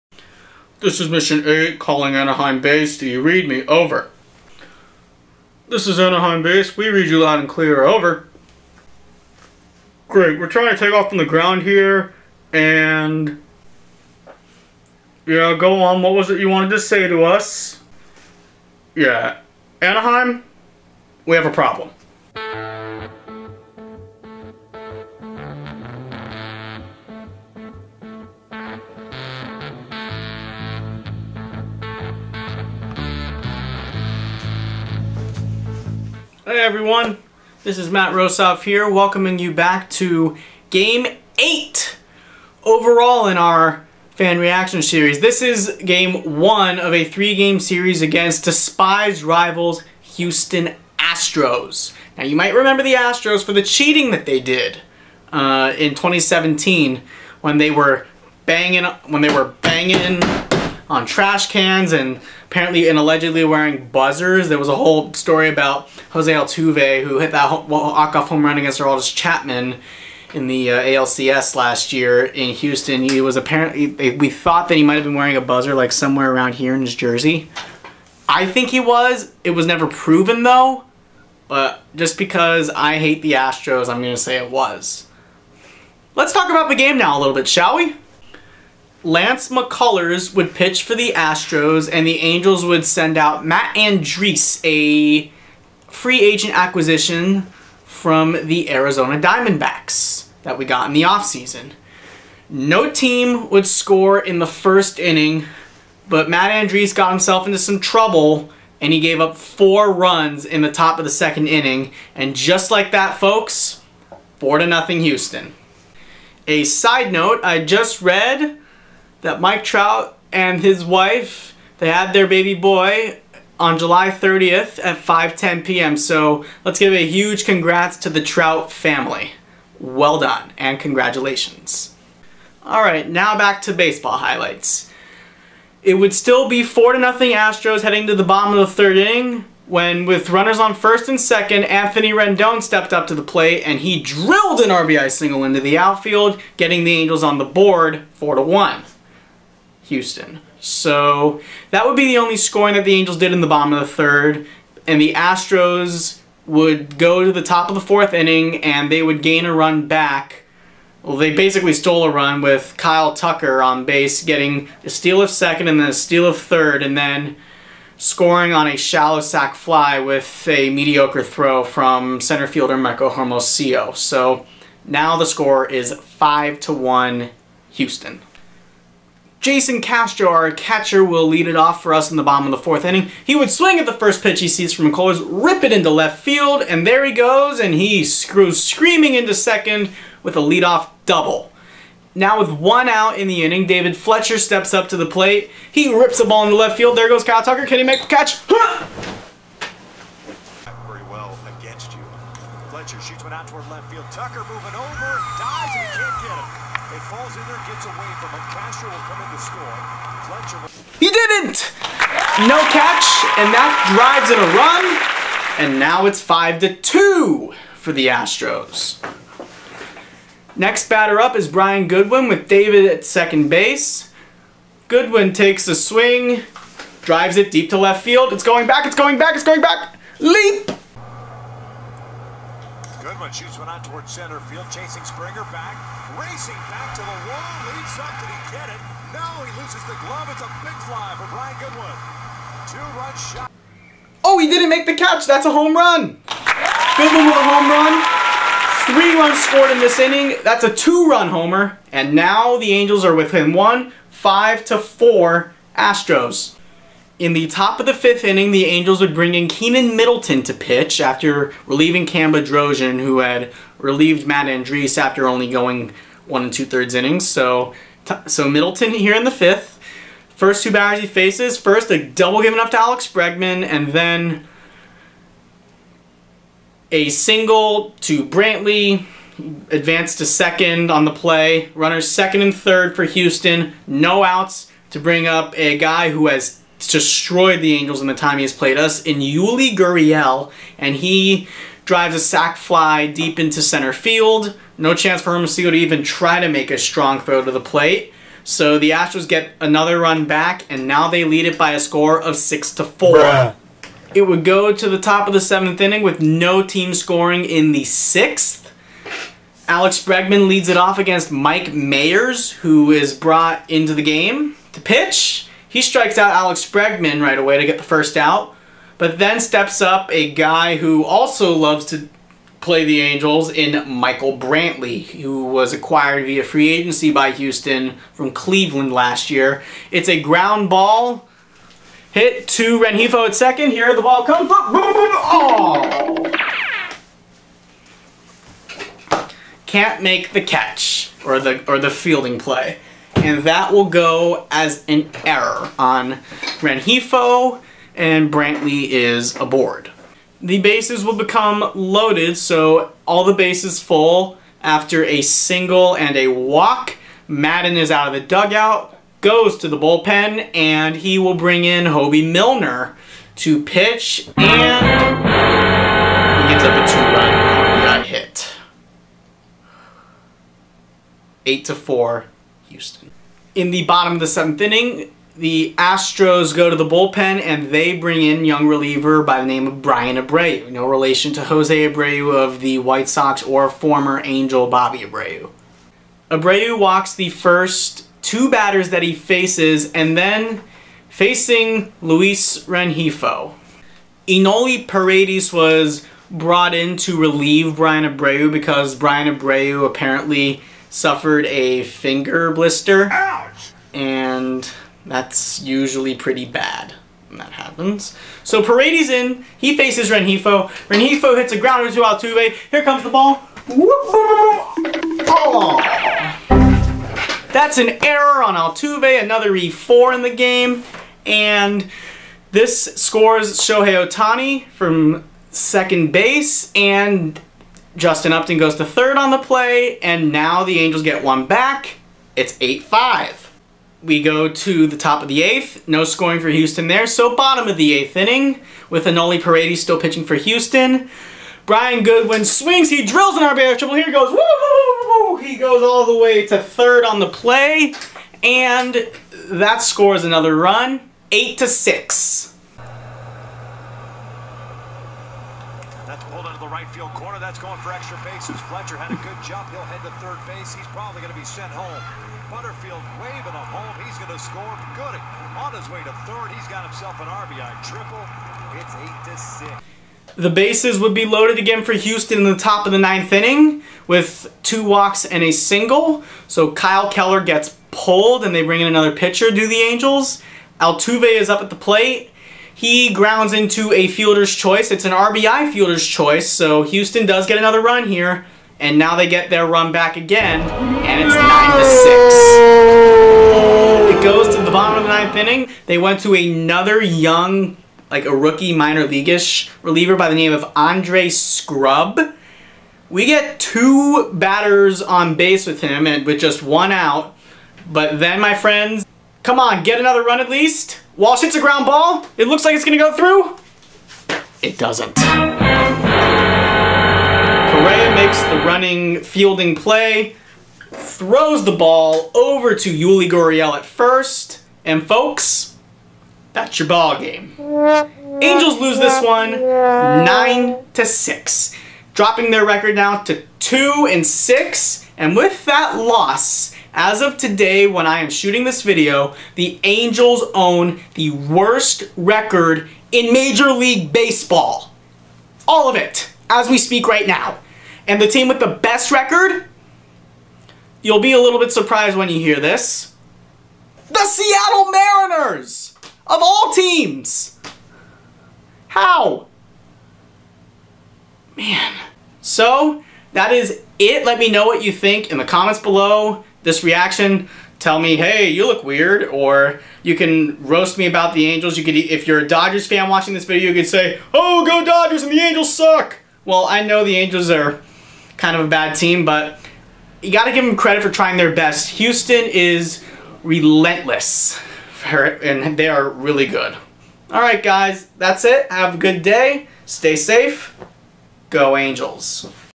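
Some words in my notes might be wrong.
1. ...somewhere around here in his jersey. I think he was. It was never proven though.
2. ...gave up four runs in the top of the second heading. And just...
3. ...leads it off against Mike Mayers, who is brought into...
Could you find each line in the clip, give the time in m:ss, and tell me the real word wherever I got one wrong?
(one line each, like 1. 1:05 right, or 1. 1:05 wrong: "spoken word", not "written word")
1. 1:15 right
2. 1:48 wrong: "inning", not "heading"
3. 5:10 right.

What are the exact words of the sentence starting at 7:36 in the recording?
That's pulled out of the right field that's going for extra bases.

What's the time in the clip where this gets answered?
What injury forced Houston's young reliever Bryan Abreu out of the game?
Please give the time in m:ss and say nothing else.
6:41.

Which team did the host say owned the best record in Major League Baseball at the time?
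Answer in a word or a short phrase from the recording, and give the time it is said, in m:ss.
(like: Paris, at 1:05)
Seattle Mariners, at 9:14.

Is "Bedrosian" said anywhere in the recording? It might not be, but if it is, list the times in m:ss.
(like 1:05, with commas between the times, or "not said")
4:22.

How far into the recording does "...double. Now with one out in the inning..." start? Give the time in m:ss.
3:11.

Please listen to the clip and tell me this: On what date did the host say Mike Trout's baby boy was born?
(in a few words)
July 30th.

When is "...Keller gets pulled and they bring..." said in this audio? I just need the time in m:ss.
7:57.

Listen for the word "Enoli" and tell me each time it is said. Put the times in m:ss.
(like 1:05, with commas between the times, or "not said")
6:34, 7:19.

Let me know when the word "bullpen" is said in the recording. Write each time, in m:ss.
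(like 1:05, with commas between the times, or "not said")
5:59, 6:16.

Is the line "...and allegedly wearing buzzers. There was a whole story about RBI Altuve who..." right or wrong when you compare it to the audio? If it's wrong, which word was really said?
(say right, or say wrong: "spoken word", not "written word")
wrong: "Jose", not "RBI".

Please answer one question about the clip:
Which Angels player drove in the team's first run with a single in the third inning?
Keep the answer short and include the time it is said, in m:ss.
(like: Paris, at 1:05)
Anthony Rendon, at 2:21.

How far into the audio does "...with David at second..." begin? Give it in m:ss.
3:42.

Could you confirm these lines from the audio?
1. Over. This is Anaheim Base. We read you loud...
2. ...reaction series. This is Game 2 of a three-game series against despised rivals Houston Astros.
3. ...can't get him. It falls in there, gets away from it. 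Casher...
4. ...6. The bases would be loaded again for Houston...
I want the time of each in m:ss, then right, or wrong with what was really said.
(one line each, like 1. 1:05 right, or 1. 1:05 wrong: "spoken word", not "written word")
1. 0:03 right
2. 0:44 wrong: "1", not "2"
3. 3:25 right
4. 7:50 right.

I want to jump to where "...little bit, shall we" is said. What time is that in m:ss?
1:27.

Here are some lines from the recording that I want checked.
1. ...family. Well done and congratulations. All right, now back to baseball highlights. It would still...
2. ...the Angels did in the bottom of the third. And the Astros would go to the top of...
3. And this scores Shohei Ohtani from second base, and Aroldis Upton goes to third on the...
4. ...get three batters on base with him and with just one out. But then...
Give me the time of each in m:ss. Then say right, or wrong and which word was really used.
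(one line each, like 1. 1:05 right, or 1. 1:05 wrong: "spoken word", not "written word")
1. 2:08 right
2. 2:32 right
3. 7:01 wrong: "Justin", not "Aroldis"
4. 8:23 wrong: "two", not "three".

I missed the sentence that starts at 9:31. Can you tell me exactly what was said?
You could, if you're a Dodgers fan watching this video, you could say, oh, go Dodgers and the Angels suck.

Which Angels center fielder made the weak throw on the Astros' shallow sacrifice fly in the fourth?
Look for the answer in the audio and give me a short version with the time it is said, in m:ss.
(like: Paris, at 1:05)
Michael Hermosillo, at 2:52.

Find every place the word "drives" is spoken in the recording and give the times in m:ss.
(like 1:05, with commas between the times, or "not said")
3:33, 3:47, 4:51.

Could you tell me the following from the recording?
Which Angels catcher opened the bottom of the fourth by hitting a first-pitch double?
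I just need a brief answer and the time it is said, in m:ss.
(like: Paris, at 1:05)
Jason Castro, at 2:59.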